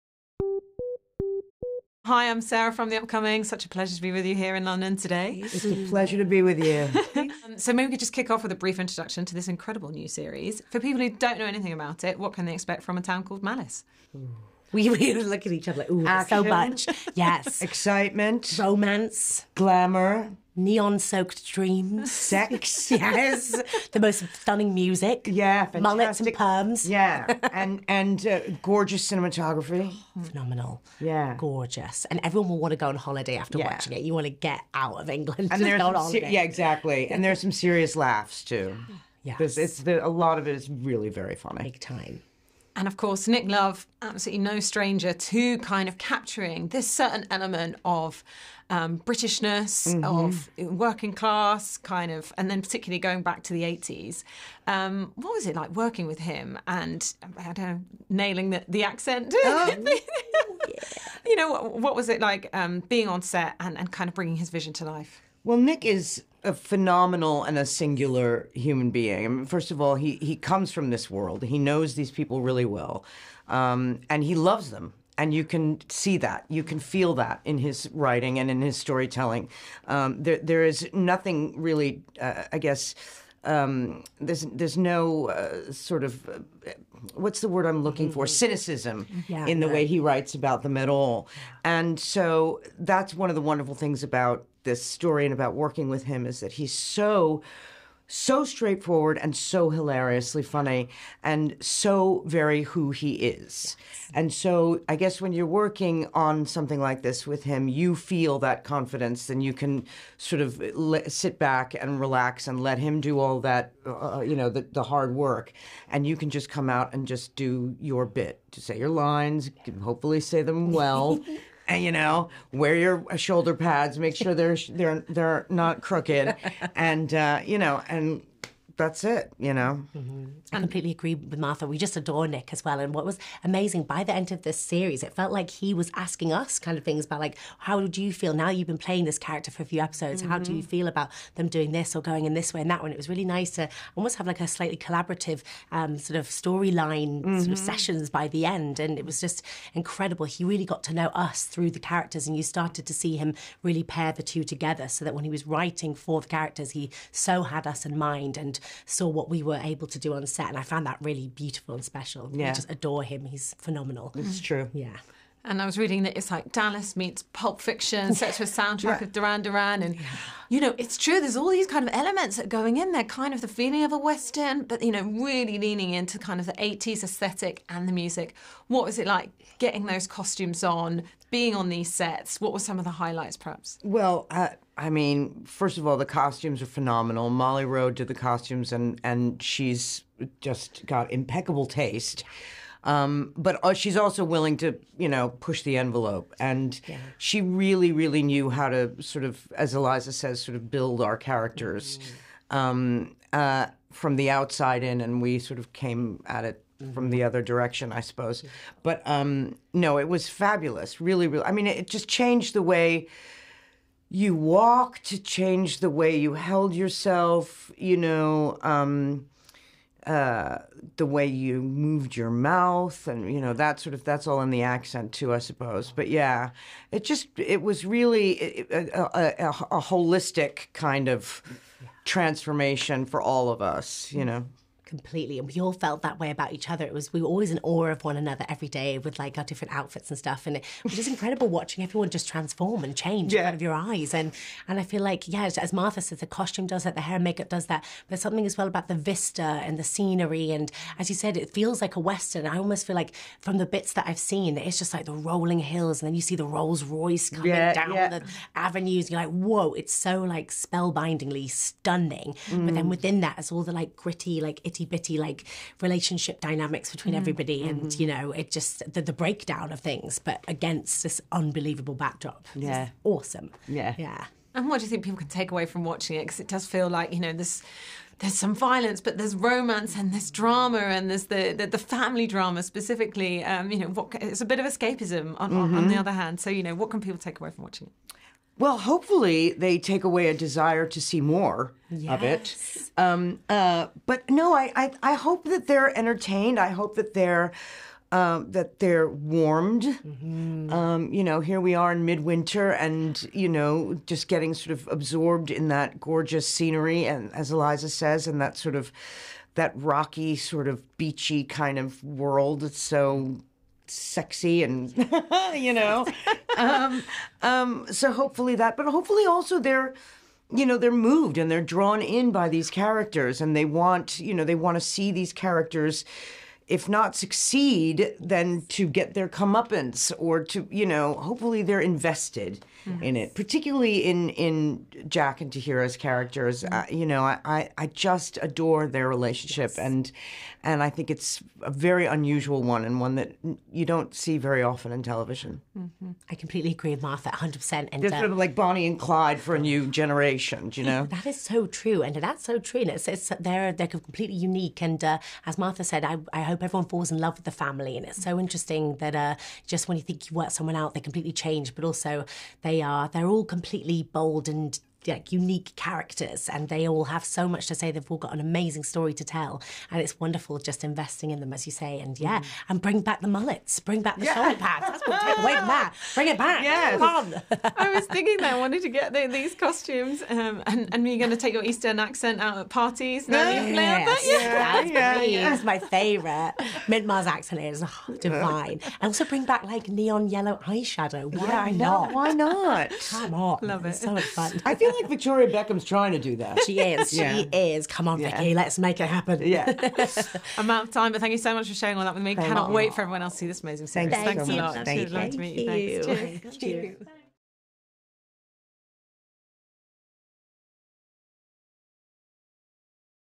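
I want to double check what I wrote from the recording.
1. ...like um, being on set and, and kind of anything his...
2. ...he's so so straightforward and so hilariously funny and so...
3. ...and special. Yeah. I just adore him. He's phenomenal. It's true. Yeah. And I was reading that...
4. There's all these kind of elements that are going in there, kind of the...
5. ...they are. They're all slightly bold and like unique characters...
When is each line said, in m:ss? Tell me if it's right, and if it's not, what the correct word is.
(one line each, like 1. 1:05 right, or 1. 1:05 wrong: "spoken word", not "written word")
1. 1:02 wrong: "bringing", not "anything"
2. 1:36 right
3. 2:41 right
4. 2:51 right
5. 6:02 wrong: "completely", not "slightly".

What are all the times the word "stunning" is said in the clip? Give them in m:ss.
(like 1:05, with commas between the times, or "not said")
0:24, 4:21.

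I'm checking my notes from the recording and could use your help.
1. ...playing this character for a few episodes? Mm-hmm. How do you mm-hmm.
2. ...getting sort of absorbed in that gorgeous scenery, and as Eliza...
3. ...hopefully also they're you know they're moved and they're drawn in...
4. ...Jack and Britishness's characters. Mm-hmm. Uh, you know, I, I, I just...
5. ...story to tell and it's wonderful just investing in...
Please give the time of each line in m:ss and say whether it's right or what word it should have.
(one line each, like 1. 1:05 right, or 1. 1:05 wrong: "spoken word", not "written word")
1. 2:18 right
2. 5:04 right
3. 5:18 right
4. 5:35 wrong: "Tahirah", not "Britishness"
5. 6:08 right.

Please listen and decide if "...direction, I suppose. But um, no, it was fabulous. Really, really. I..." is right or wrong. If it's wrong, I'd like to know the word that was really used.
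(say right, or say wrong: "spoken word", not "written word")
right.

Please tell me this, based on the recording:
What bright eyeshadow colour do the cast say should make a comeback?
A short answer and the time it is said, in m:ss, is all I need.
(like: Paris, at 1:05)
Neon yellow, at 6:29.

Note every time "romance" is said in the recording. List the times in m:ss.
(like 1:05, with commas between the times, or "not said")
0:18, 4:39.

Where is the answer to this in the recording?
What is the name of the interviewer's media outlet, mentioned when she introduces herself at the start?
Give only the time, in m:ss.
0:02.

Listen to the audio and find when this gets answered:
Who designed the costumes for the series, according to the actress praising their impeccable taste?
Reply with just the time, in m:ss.
3:07.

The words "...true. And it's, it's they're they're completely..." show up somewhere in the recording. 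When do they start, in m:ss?
5:52.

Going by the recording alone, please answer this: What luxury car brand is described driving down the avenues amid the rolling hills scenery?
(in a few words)
Rolls Royce.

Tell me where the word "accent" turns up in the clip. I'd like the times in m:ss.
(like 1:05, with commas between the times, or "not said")
0:58, 3:44, 6:21, 6:27.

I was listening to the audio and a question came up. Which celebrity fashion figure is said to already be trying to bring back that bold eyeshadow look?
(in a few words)
Victoria Beckham.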